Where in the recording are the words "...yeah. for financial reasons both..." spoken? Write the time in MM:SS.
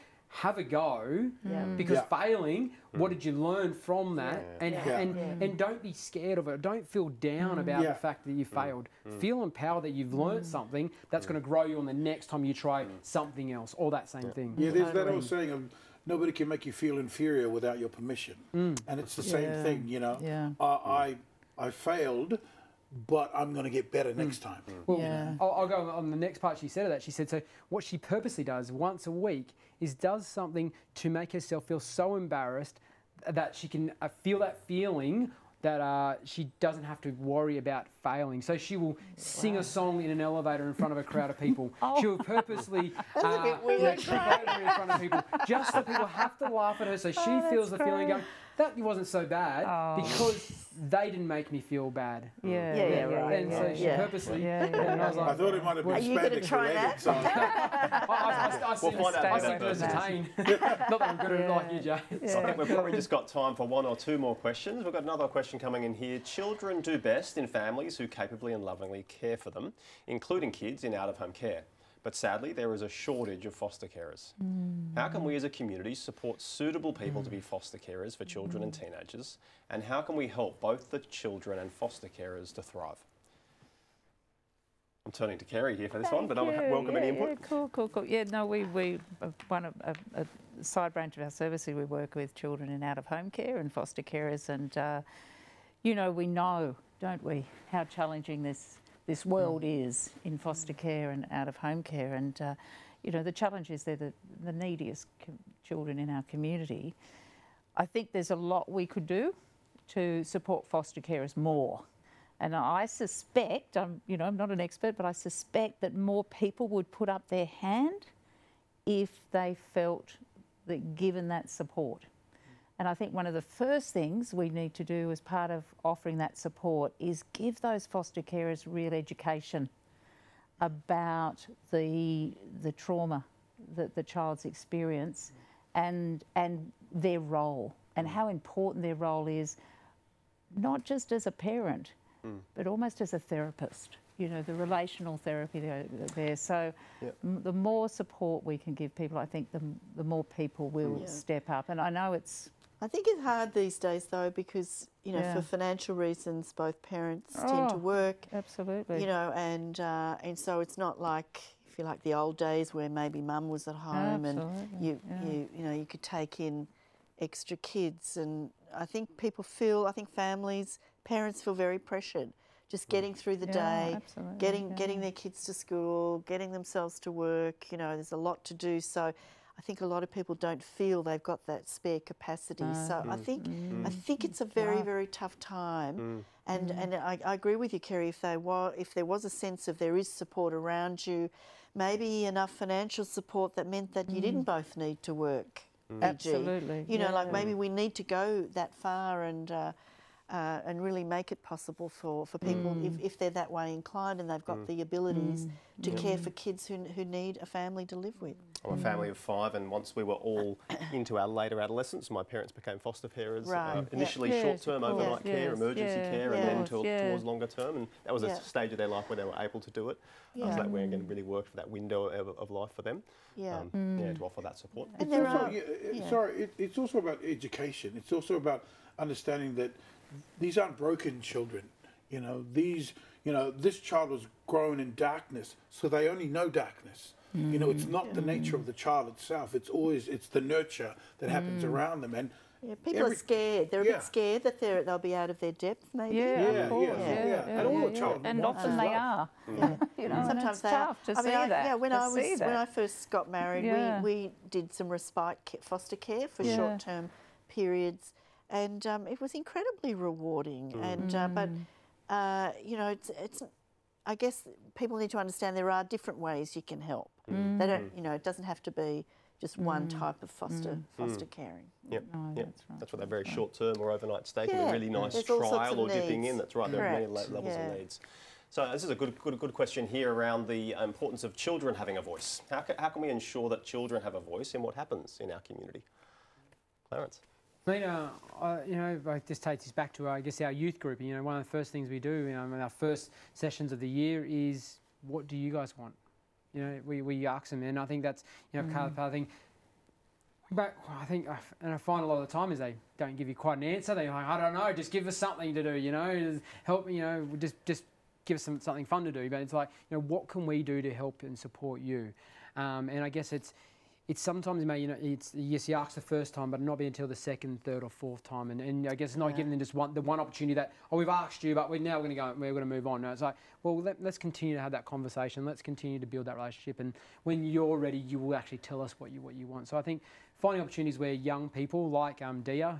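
02:35.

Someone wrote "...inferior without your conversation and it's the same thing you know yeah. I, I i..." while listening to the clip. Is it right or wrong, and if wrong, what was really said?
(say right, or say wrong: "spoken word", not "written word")
wrong: "permission", not "conversation".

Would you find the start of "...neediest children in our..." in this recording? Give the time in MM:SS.
01:44.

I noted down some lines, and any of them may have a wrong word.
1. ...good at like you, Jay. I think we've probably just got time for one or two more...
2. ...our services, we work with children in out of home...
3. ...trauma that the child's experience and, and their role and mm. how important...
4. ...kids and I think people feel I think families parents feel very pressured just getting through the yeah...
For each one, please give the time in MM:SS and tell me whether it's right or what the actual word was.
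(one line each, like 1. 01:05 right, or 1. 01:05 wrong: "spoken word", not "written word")
1. 01:01 right
2. 01:31 right
3. 02:12 right
4. 02:47 right.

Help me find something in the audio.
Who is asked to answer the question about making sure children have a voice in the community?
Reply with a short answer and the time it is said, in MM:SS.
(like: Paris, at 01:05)
Clarence, at 04:46.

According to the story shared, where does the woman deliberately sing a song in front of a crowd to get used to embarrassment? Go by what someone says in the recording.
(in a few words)
In an elevator.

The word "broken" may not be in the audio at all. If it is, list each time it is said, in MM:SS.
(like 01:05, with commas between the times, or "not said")
03:50.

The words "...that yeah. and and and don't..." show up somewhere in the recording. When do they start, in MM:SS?
00:04.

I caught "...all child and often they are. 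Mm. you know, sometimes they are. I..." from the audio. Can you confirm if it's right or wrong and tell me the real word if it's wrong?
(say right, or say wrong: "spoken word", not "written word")
right.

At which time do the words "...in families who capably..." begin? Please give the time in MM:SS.
01:07.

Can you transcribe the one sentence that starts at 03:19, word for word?
Uh, uh, and really make it possible for, for people mm.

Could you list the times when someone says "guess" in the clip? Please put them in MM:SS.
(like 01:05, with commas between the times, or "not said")
04:24, 04:50, 05:13, 05:18.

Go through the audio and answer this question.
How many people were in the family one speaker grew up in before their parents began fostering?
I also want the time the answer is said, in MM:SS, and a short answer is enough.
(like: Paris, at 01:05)
5, at 03:28.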